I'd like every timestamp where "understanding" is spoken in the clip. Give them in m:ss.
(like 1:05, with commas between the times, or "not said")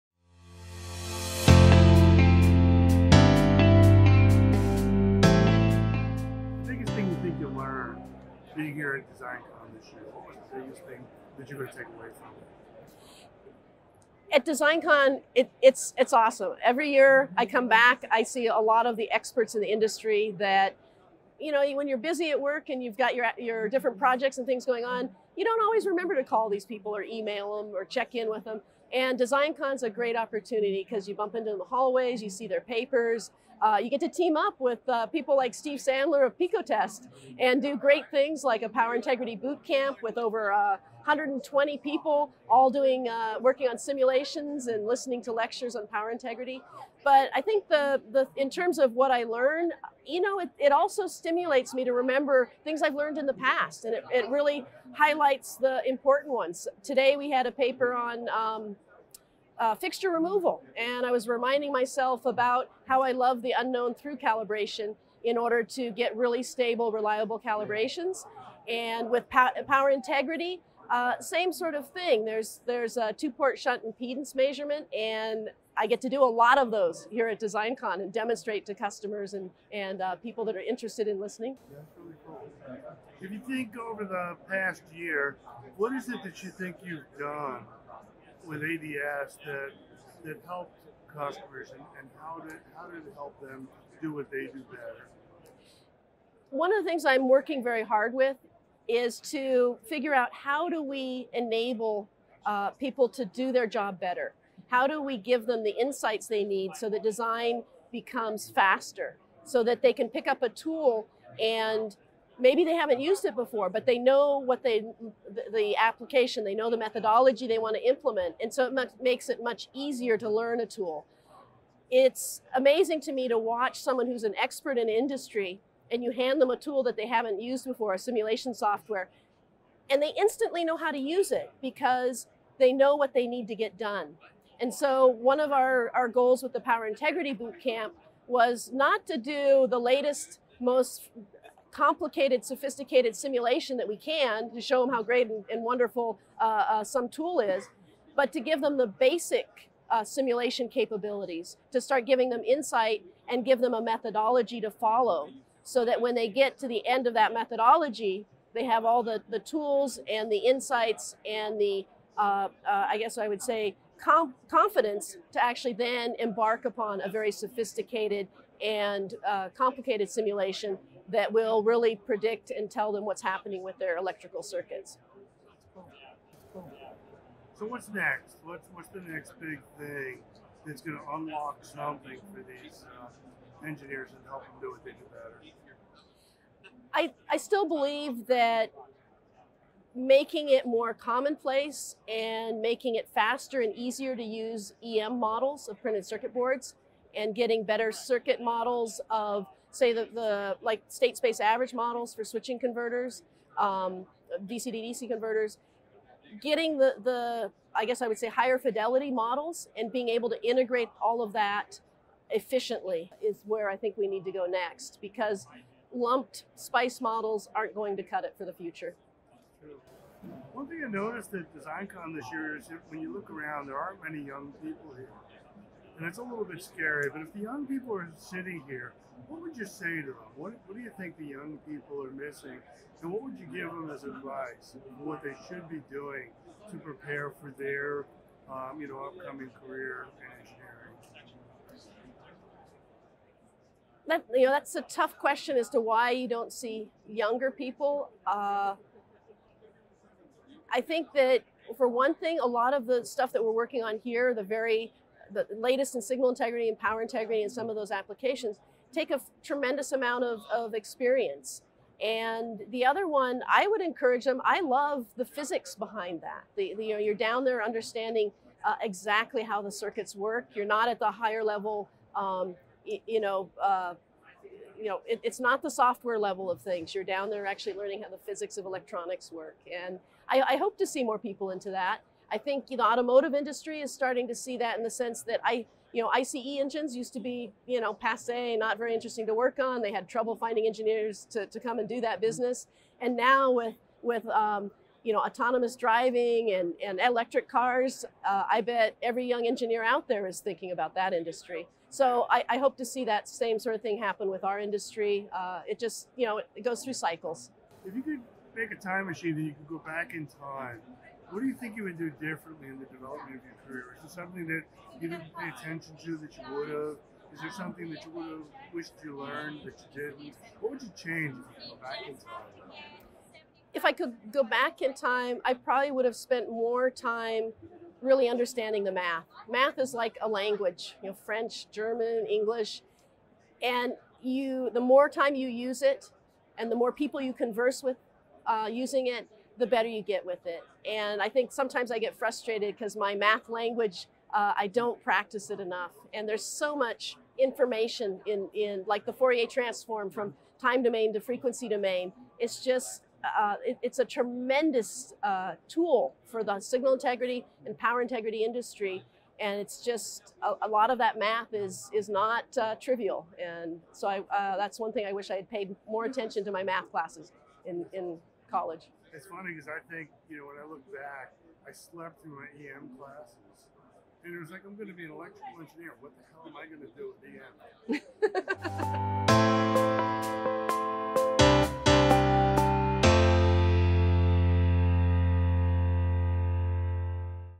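4:27, 5:28.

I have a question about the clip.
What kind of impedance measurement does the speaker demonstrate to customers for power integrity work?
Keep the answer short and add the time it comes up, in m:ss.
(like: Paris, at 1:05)
two-port shunt impedance, at 1:13.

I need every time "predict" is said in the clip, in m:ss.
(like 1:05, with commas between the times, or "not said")
2:51.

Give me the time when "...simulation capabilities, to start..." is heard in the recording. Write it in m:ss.
2:30.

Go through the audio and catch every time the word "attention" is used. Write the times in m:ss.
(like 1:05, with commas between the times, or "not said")
5:15, 6:06.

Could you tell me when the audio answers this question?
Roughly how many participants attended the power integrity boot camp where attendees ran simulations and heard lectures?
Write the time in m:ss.
0:40.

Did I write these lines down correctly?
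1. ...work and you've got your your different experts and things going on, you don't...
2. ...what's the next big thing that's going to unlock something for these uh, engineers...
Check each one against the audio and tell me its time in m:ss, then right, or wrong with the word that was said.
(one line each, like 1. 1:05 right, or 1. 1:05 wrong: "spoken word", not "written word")
1. 0:22 wrong: "projects", not "experts"
2. 2:58 right.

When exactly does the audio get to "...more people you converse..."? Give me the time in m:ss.
5:36.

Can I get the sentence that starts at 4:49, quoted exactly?
They had trouble finding engineers to, to come and do that mm-hmm.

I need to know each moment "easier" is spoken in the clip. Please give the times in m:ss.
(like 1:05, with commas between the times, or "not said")
1:59, 3:13.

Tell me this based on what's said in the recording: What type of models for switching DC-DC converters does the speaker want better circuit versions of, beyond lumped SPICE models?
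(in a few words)
state space average models.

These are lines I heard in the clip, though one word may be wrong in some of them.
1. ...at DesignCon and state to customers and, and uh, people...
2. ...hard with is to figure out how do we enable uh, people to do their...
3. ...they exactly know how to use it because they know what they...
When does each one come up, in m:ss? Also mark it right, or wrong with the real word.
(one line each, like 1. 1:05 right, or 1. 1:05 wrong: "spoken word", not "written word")
1. 1:17 wrong: "demonstrate", not "state"
2. 1:37 right
3. 2:10 wrong: "instantly", not "exactly".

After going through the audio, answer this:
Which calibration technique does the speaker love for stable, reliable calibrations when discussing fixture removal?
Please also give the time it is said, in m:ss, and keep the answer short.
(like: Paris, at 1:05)
unknown through calibration, at 1:03.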